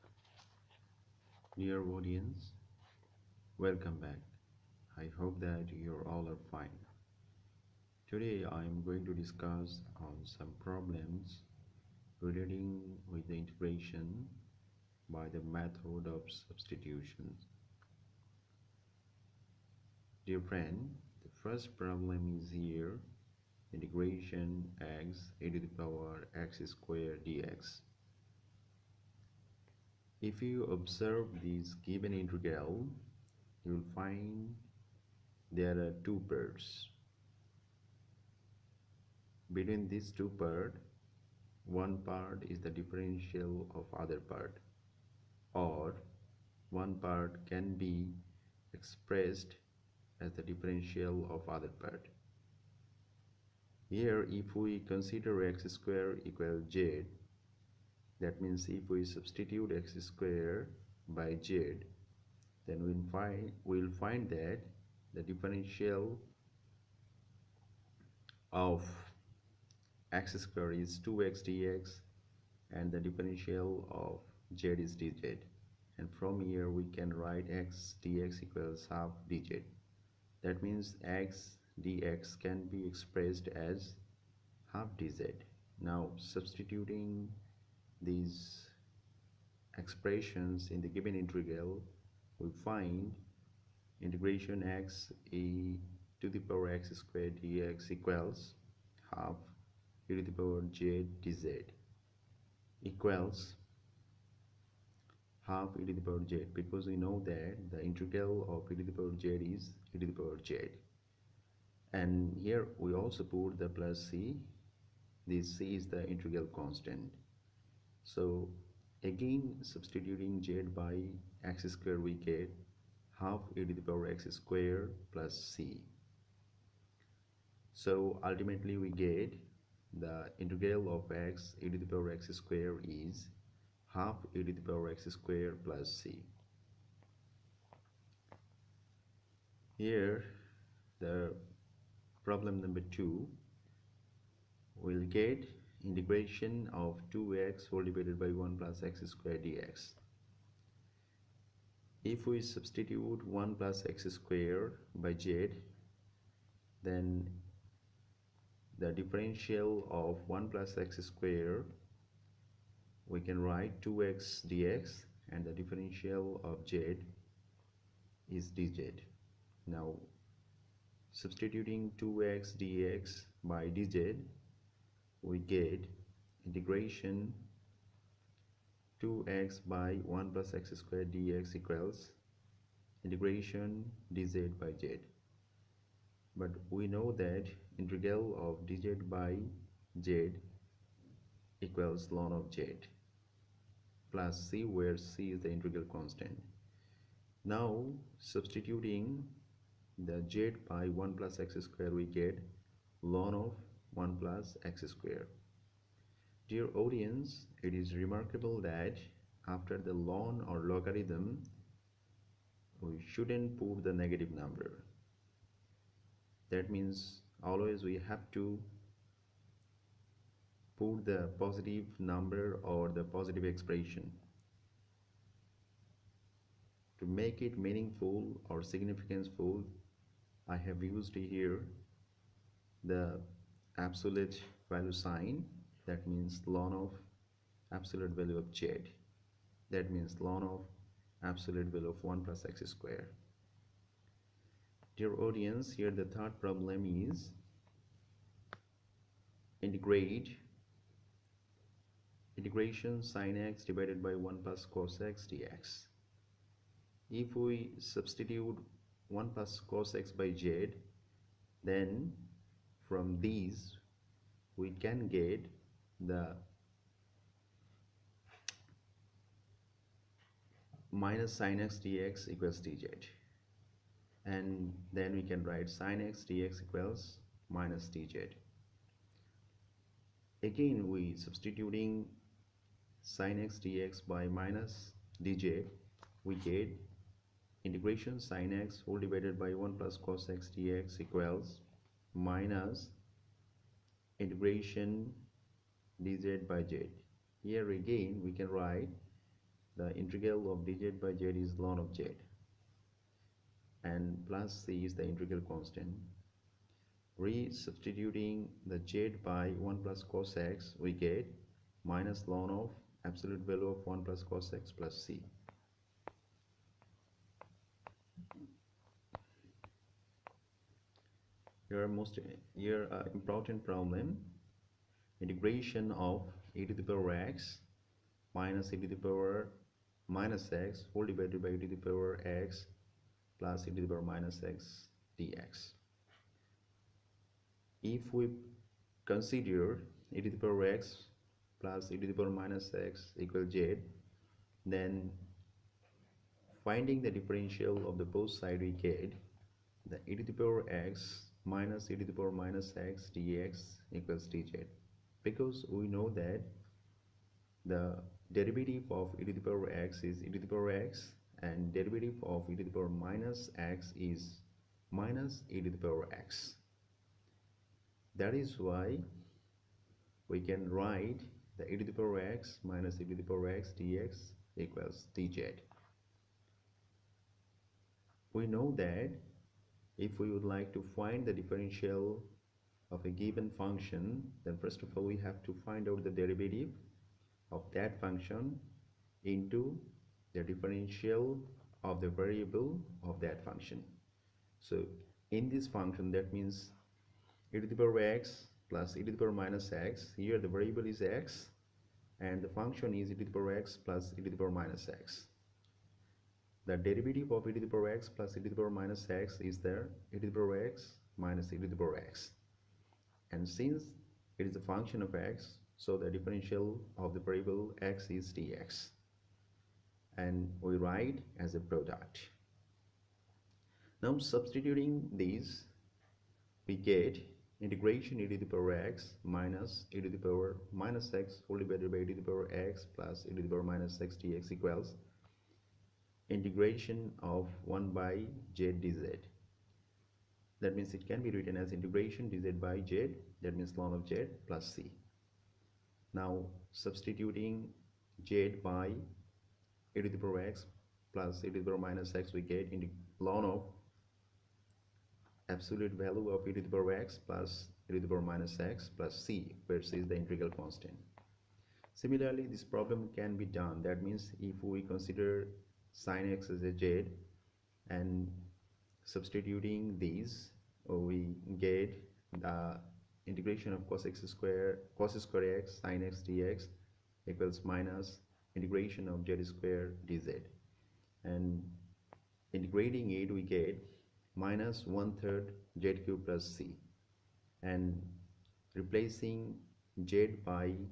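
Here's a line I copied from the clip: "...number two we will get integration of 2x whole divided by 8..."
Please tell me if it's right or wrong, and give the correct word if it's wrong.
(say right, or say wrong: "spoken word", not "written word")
wrong: "1", not "8".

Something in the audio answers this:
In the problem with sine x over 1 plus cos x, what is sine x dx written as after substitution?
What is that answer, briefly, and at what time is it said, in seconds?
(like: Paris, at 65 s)
minus dz, at 275 s.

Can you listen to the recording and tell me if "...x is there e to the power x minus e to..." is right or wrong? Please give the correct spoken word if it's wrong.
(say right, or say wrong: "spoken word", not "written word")
right.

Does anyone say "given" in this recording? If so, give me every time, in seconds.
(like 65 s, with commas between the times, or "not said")
31 s, 90 s, 383 s.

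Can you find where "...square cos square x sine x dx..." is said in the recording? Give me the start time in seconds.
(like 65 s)
474 s.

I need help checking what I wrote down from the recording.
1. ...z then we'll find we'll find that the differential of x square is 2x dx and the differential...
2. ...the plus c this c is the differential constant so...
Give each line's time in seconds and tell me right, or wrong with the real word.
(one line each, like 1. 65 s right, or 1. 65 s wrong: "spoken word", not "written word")
1. 61 s right
2. 113 s wrong: "integral", not "differential".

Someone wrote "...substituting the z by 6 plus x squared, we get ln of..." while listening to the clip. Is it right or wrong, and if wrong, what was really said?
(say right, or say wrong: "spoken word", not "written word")
wrong: "1", not "6".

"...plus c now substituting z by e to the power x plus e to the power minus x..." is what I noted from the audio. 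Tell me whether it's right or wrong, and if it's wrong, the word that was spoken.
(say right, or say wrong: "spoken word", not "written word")
right.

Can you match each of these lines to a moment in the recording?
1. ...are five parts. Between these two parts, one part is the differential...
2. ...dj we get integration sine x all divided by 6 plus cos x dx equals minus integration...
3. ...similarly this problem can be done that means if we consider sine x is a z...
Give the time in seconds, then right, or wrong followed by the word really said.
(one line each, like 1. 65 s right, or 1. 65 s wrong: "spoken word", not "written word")
1. 35 s wrong: "two", not "five"
2. 285 s wrong: "1", not "6"
3. 462 s right.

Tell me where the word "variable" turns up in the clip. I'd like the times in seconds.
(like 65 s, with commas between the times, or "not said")
392 s, 400 s, 417 s.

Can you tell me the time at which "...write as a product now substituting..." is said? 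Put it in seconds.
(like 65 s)
420 s.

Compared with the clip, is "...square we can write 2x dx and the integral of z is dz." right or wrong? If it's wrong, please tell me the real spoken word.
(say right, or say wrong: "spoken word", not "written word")
wrong: "differential", not "integral".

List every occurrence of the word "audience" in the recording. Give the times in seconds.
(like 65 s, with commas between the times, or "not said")
1 s, 206 s, 245 s.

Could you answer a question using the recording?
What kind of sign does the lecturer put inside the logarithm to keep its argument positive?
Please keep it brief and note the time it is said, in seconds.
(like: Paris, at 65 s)
absolute value sign, at 233 s.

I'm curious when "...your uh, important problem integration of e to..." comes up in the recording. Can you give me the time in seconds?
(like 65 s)
322 s.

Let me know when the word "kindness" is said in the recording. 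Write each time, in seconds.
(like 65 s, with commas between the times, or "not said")
not said.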